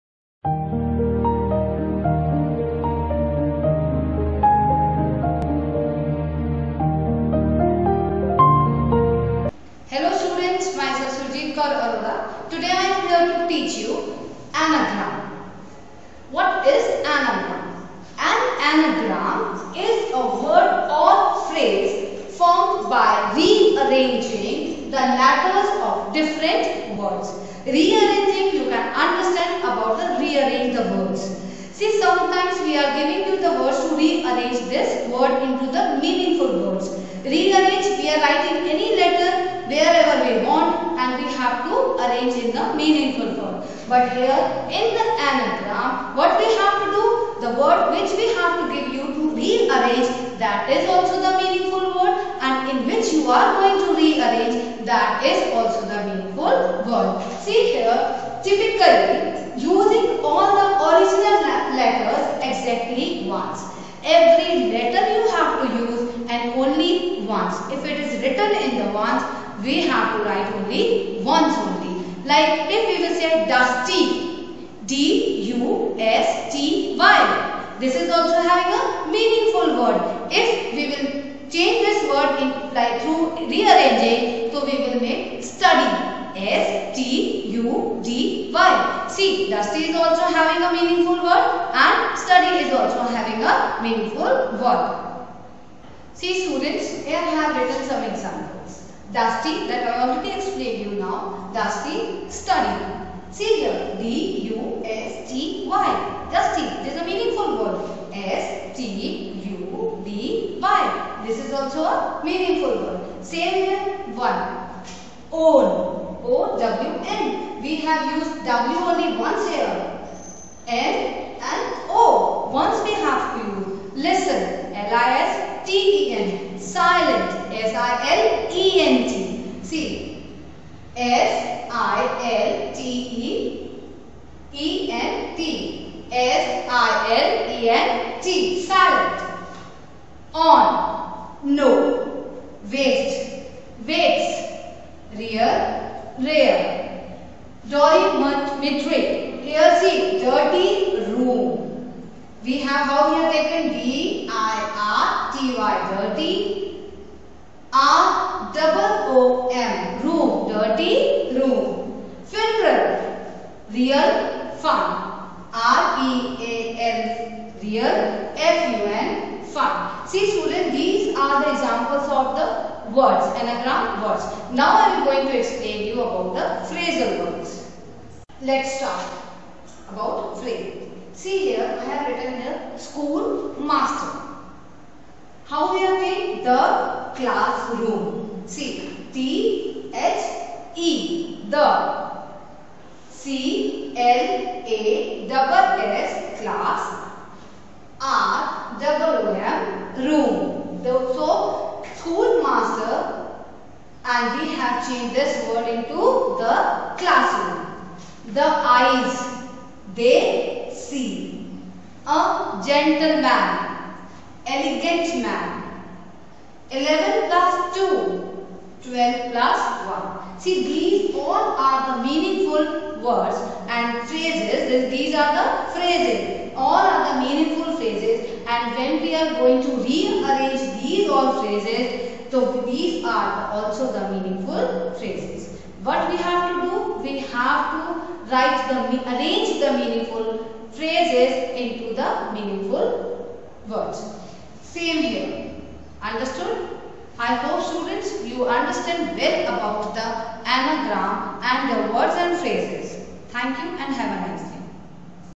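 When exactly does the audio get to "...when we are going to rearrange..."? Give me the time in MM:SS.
03:48.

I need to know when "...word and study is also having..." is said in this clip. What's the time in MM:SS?
01:31.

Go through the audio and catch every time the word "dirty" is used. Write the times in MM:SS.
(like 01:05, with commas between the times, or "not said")
02:30, 02:35, 02:40.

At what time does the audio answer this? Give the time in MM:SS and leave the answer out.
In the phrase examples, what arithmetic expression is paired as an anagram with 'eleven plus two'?
03:38.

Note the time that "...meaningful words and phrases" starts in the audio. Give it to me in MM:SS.
03:42.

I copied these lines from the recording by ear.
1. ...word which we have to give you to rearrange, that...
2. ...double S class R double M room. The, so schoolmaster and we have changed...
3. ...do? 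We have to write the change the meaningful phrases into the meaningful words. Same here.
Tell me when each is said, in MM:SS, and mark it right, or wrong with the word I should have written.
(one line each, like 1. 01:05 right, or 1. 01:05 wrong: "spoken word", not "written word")
1. 00:47 right
2. 03:15 right
3. 03:56 wrong: "arrange", not "change".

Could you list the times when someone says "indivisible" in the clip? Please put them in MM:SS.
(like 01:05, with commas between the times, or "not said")
not said.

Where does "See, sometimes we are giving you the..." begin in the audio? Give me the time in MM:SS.
00:31.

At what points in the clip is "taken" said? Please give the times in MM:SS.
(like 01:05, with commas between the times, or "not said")
02:33.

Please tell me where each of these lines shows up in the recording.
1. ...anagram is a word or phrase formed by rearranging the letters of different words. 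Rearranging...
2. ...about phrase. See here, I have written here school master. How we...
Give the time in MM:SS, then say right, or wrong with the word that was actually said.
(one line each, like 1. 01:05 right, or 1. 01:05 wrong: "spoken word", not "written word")
1. 00:18 right
2. 02:59 right.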